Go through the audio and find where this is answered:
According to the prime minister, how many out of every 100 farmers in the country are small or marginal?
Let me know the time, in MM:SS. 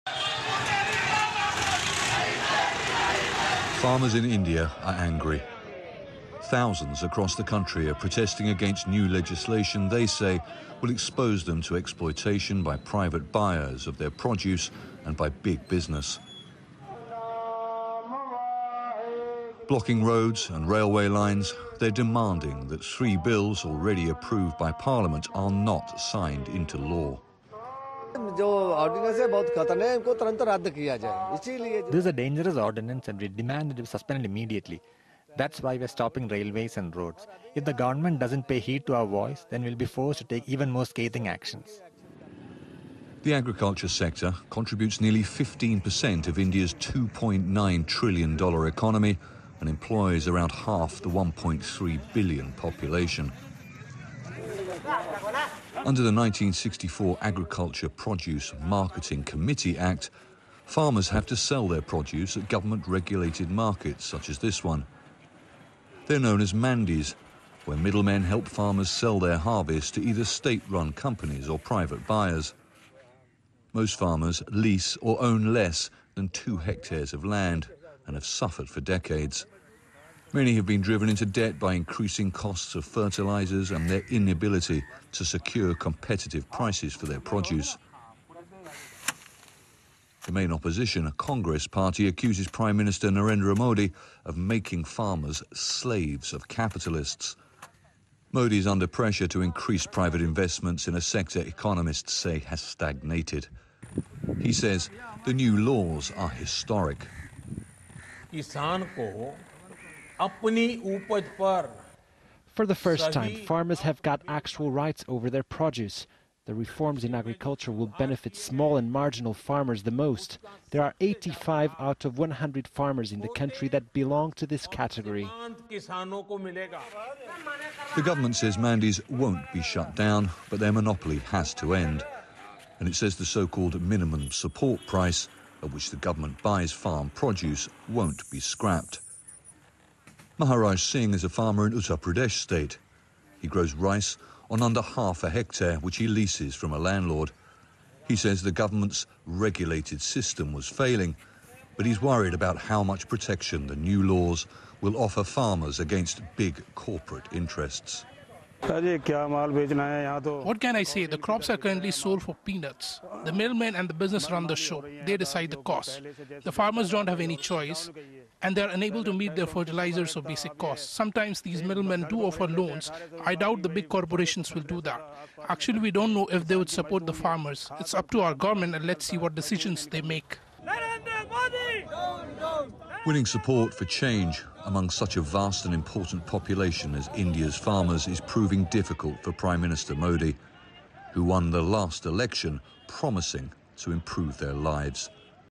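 02:00.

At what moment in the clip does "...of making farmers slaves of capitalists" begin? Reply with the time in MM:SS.
01:34.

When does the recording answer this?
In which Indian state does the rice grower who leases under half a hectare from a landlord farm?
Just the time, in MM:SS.
02:21.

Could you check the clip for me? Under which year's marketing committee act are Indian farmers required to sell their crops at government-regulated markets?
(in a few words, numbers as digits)
1964.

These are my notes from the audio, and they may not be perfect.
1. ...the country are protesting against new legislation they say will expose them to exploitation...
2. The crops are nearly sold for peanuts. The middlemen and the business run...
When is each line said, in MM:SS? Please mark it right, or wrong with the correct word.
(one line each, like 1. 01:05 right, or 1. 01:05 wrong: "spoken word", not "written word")
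1. 00:07 right
2. 02:41 wrong: "currently", not "nearly".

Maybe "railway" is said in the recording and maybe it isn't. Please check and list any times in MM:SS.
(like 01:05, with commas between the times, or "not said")
00:20, 00:36.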